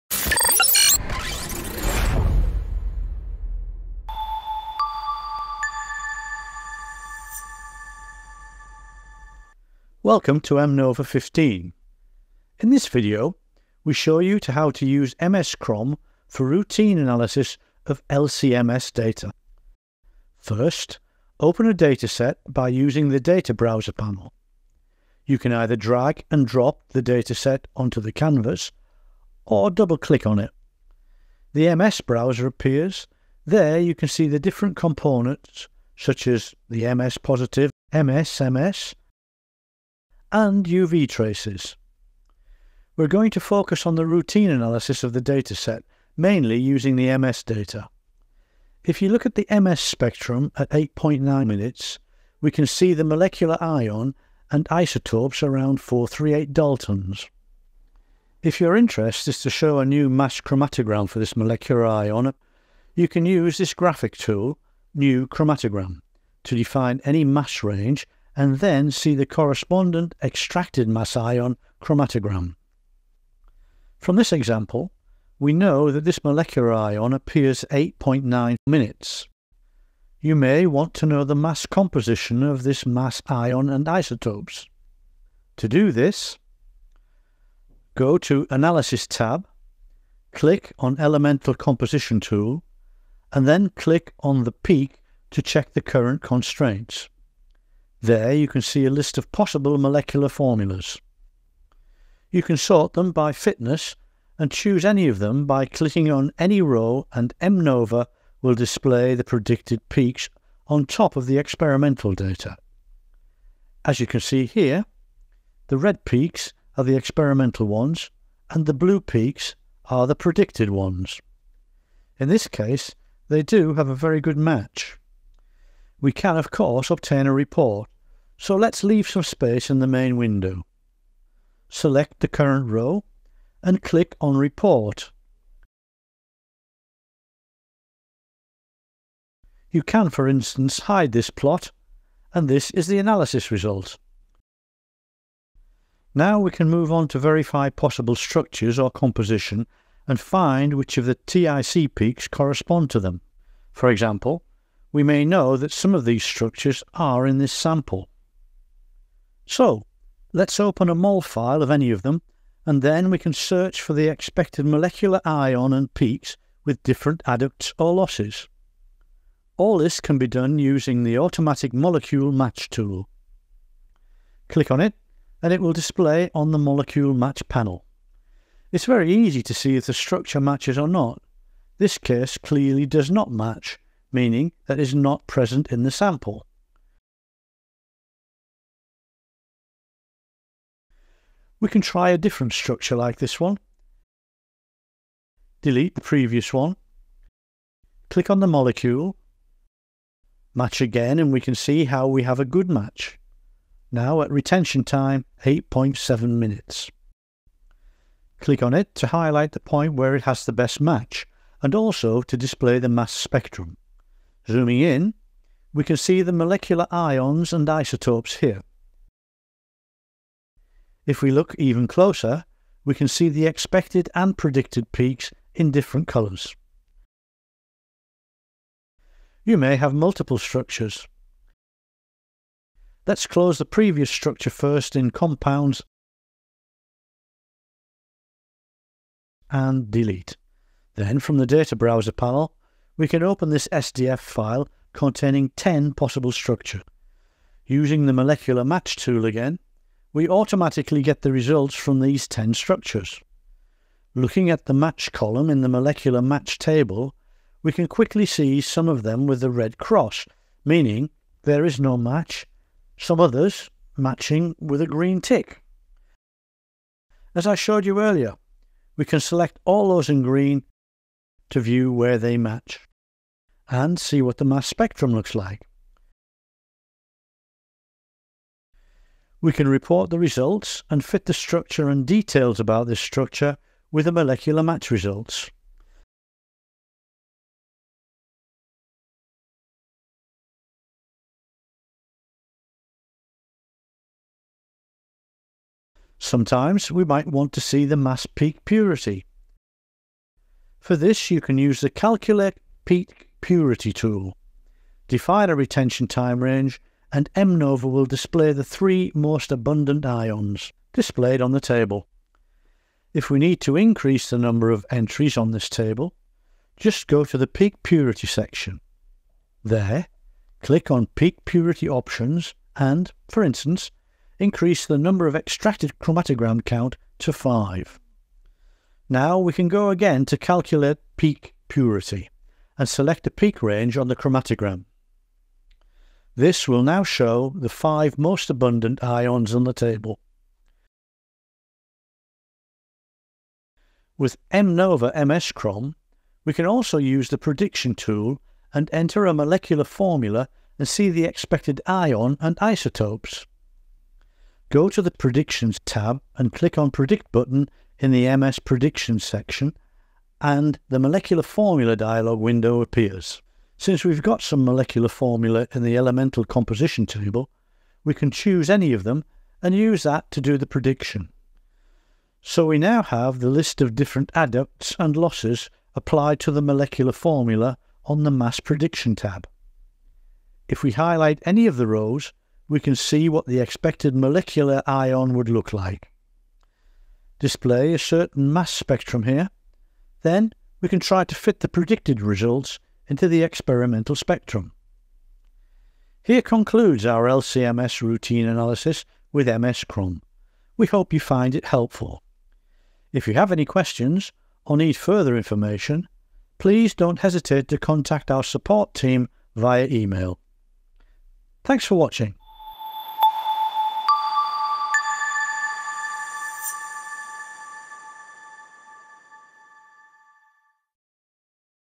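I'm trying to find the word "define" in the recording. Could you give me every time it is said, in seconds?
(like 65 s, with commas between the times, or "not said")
66 s, 305 s.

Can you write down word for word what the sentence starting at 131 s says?
Select the current row and click on Report.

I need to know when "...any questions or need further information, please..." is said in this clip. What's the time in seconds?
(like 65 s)
403 s.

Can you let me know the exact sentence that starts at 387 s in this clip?
Display a certain mass spectrum here.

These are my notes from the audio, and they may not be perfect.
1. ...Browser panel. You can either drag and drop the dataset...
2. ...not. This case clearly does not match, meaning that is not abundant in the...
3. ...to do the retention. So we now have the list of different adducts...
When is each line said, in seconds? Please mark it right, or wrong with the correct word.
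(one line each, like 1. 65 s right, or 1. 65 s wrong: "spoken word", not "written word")
1. 23 s right
2. 180 s wrong: "present", not "abundant"
3. 370 s wrong: "prediction", not "retention".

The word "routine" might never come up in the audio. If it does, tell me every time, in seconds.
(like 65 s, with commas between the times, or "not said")
16 s, 44 s, 398 s.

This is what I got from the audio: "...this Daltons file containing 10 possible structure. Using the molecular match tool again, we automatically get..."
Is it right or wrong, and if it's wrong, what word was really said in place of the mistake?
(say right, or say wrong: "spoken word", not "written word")
wrong: "SDF", not "Daltons".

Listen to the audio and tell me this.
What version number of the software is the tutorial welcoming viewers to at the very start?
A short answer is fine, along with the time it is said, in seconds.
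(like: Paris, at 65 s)
15, at 11 s.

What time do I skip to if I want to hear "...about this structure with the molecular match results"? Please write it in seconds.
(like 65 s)
282 s.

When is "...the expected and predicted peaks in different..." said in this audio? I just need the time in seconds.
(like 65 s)
223 s.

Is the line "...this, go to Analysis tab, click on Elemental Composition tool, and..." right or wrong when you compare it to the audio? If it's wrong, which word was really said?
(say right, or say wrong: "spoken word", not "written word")
right.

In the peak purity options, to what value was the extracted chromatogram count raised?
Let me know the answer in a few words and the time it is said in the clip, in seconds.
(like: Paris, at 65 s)
5, at 327 s.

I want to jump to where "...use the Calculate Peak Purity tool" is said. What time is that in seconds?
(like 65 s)
301 s.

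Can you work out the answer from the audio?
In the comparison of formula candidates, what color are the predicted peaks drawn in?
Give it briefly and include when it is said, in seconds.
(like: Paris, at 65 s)
Blue, at 118 s.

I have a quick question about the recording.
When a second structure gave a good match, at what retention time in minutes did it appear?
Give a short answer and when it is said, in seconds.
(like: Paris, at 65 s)
8.7, at 205 s.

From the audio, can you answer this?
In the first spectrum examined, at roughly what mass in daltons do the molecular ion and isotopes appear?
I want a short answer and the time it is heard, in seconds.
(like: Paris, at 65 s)
438, at 55 s.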